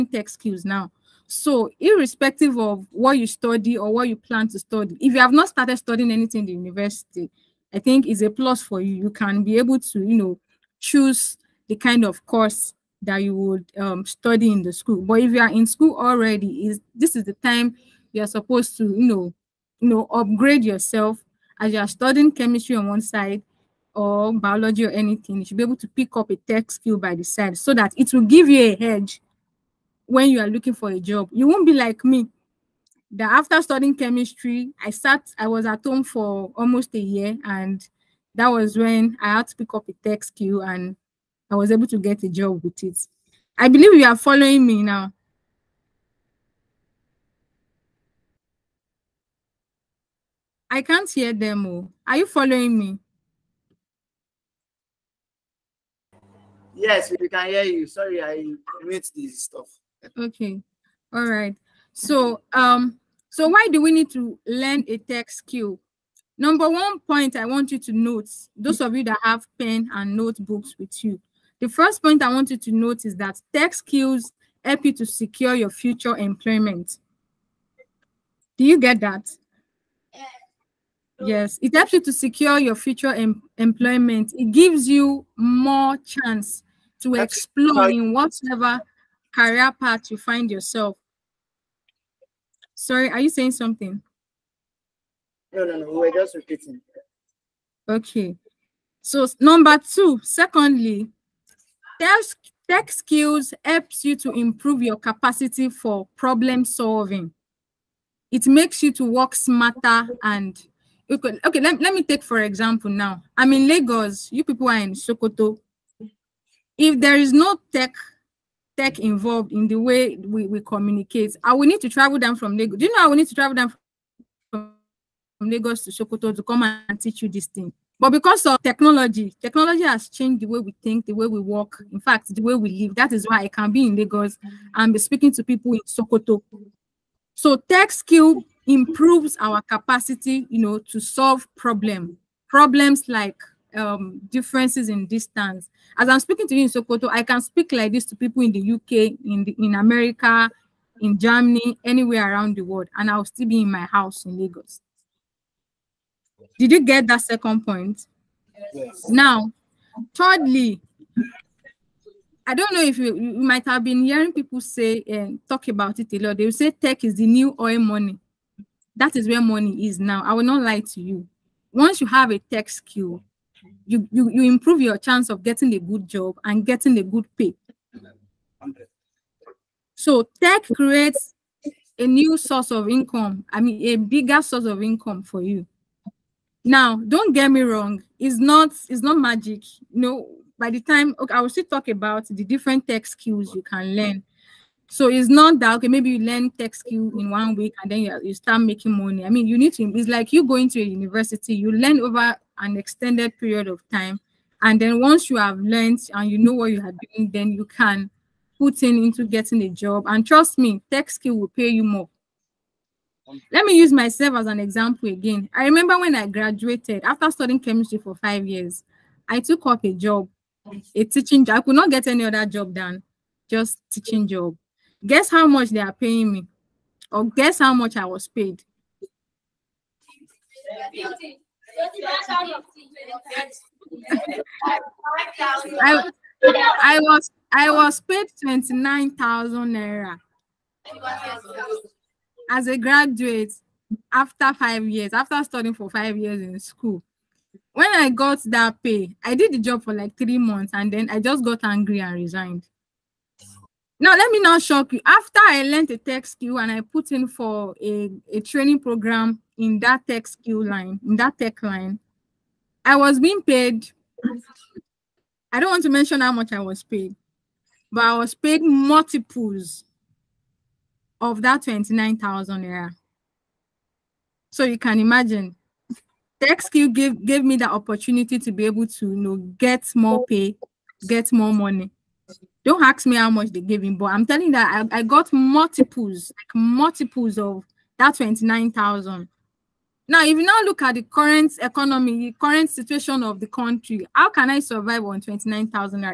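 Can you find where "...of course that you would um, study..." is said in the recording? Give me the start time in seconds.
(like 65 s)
12 s.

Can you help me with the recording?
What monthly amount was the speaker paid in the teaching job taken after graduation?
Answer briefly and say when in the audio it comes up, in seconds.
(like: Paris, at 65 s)
29,000 naira, at 238 s.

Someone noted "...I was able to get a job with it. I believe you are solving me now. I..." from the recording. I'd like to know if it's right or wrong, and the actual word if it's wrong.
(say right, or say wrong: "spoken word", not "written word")
wrong: "following", not "solving".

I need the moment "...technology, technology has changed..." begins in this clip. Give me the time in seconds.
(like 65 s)
128 s.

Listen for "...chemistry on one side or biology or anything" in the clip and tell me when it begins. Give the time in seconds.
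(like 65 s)
22 s.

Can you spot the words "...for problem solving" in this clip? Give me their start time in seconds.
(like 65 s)
105 s.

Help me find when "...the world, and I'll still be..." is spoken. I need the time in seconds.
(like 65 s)
152 s.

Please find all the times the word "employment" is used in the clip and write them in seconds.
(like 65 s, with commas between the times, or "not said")
76 s, 83 s.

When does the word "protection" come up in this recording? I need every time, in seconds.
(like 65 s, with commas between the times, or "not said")
not said.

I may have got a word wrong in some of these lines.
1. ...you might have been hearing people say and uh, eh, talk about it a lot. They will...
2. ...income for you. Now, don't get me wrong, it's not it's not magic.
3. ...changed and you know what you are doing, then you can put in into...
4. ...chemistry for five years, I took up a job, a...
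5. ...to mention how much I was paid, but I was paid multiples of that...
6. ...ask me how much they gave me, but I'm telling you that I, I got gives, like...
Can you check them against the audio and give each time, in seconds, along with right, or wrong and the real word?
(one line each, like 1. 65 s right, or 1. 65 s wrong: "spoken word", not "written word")
1. 163 s right
2. 184 s right
3. 205 s wrong: "learned", not "changed"
4. 217 s right
5. 265 s right
6. 282 s wrong: "multiples", not "gives".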